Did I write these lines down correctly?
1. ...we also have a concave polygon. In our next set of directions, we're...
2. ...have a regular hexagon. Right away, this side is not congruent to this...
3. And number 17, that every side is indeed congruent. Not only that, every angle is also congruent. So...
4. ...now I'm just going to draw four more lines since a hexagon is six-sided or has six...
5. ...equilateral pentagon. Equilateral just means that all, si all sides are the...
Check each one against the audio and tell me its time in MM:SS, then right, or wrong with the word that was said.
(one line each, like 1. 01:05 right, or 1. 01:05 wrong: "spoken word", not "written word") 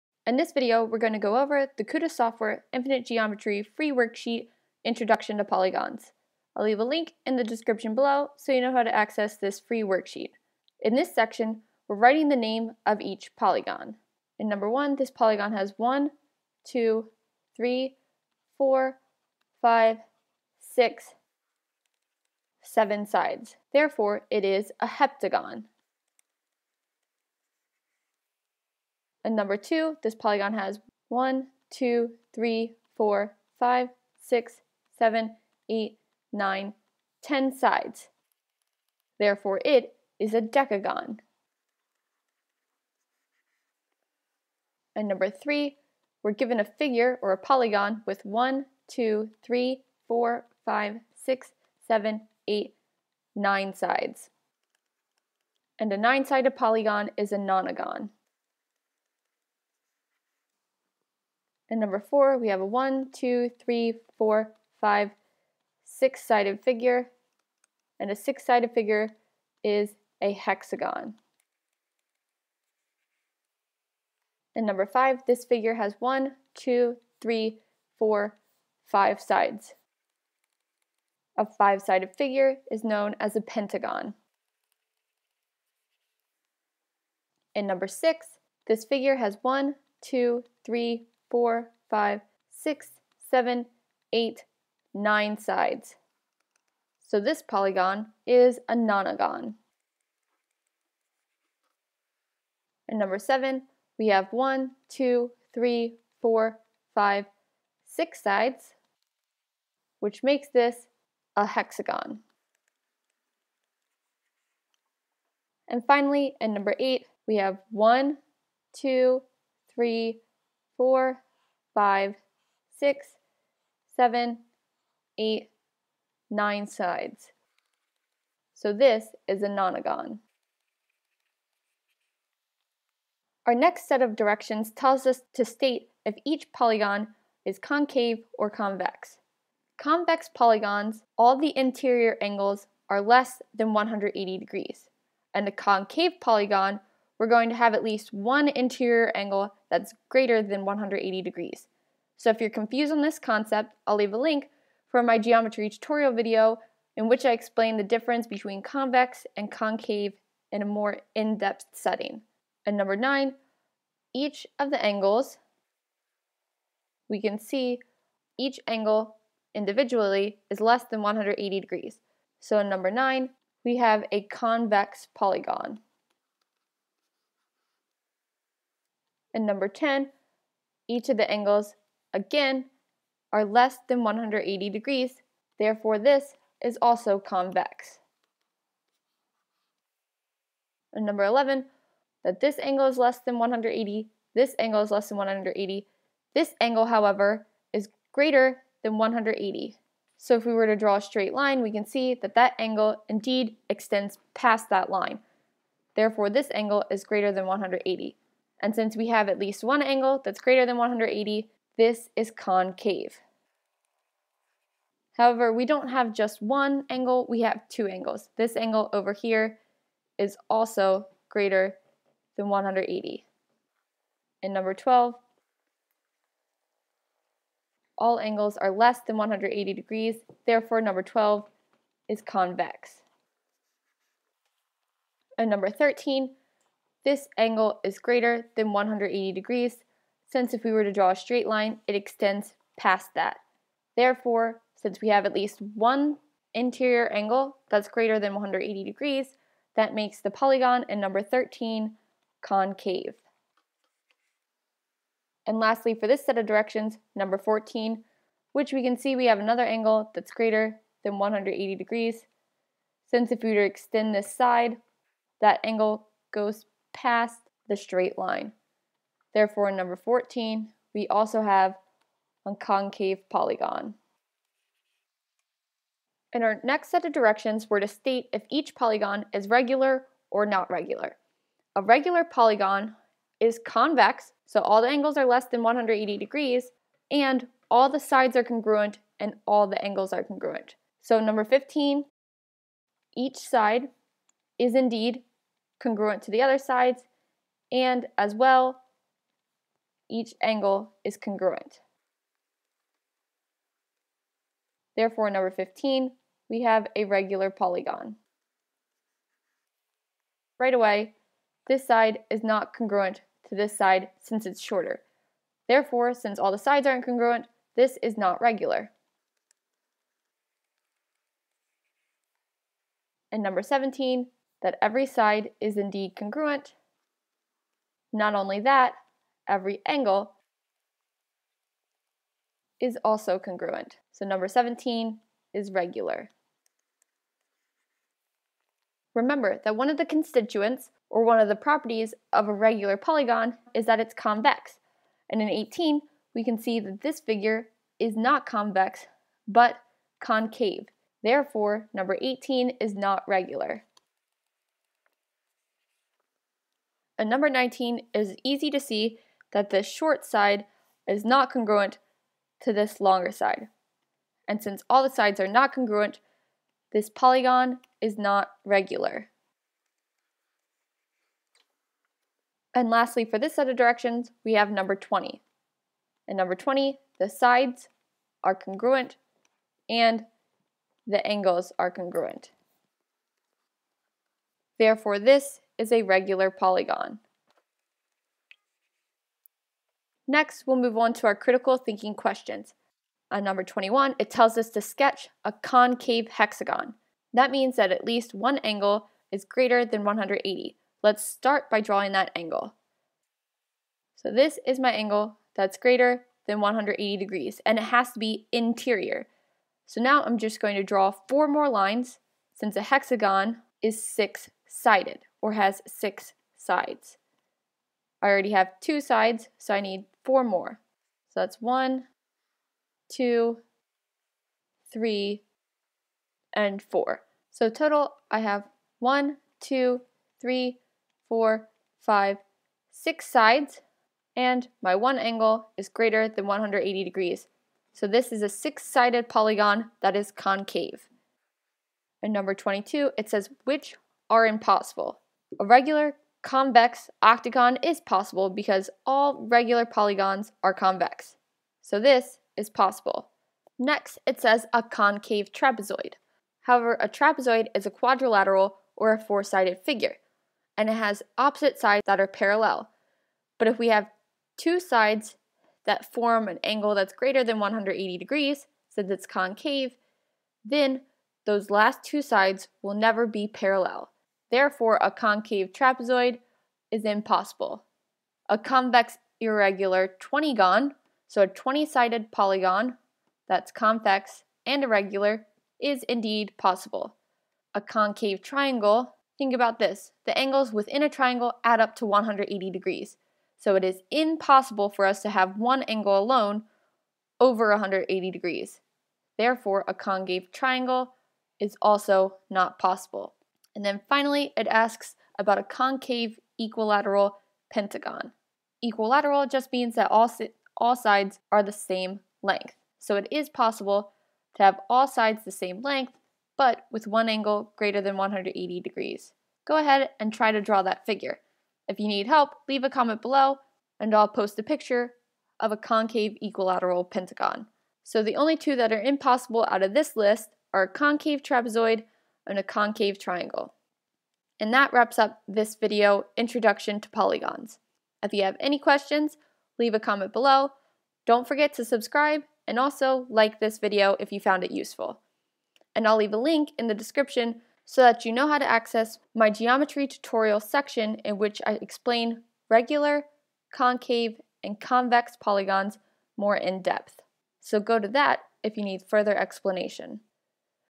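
1. 04:30 right
2. 05:06 wrong: "polygon", not "hexagon"
3. 05:23 right
4. 06:50 right
5. 08:26 right.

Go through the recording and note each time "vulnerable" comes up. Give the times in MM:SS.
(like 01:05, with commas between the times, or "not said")
not said.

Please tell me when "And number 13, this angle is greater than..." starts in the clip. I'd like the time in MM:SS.
03:55.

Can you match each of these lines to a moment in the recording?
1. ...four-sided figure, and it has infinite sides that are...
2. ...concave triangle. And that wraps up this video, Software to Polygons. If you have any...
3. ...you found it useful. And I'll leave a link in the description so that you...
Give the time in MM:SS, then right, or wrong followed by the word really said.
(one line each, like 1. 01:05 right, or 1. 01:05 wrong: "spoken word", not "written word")
1. 07:39 wrong: "opposite", not "infinite"
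2. 08:52 wrong: "Introduction", not "Software"
3. 09:04 right.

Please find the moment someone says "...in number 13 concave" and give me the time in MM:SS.
04:10.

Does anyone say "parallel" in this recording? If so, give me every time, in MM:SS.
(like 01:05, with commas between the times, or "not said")
07:42, 07:53.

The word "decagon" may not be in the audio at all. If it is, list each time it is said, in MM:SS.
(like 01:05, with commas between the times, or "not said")
00:40.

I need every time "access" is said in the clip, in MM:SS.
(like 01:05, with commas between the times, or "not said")
00:08, 09:08.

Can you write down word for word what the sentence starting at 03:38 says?
This angle over here is also greater than 180.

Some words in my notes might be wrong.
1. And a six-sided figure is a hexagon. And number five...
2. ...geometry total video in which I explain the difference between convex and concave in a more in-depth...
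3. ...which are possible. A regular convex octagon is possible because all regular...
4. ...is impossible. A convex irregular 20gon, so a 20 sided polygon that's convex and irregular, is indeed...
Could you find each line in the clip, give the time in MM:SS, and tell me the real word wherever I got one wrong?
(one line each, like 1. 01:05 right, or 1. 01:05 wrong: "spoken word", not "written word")
1. 01:07 right
2. 02:35 wrong: "tutorial", not "total"
3. 07:23 wrong: "impossible", not "possible"
4. 07:56 right.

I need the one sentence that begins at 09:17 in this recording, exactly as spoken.
So go to that if you need further explanation.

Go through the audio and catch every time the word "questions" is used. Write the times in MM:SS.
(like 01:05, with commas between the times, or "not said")
06:32, 08:58.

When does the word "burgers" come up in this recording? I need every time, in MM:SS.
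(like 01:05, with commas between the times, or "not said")
not said.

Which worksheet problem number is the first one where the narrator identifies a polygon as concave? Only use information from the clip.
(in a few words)
11.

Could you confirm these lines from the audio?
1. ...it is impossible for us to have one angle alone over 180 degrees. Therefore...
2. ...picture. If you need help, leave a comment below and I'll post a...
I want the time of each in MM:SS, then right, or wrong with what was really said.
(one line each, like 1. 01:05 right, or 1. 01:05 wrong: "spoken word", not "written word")
1. 08:13 right
2. 08:41 wrong: "figure", not "picture".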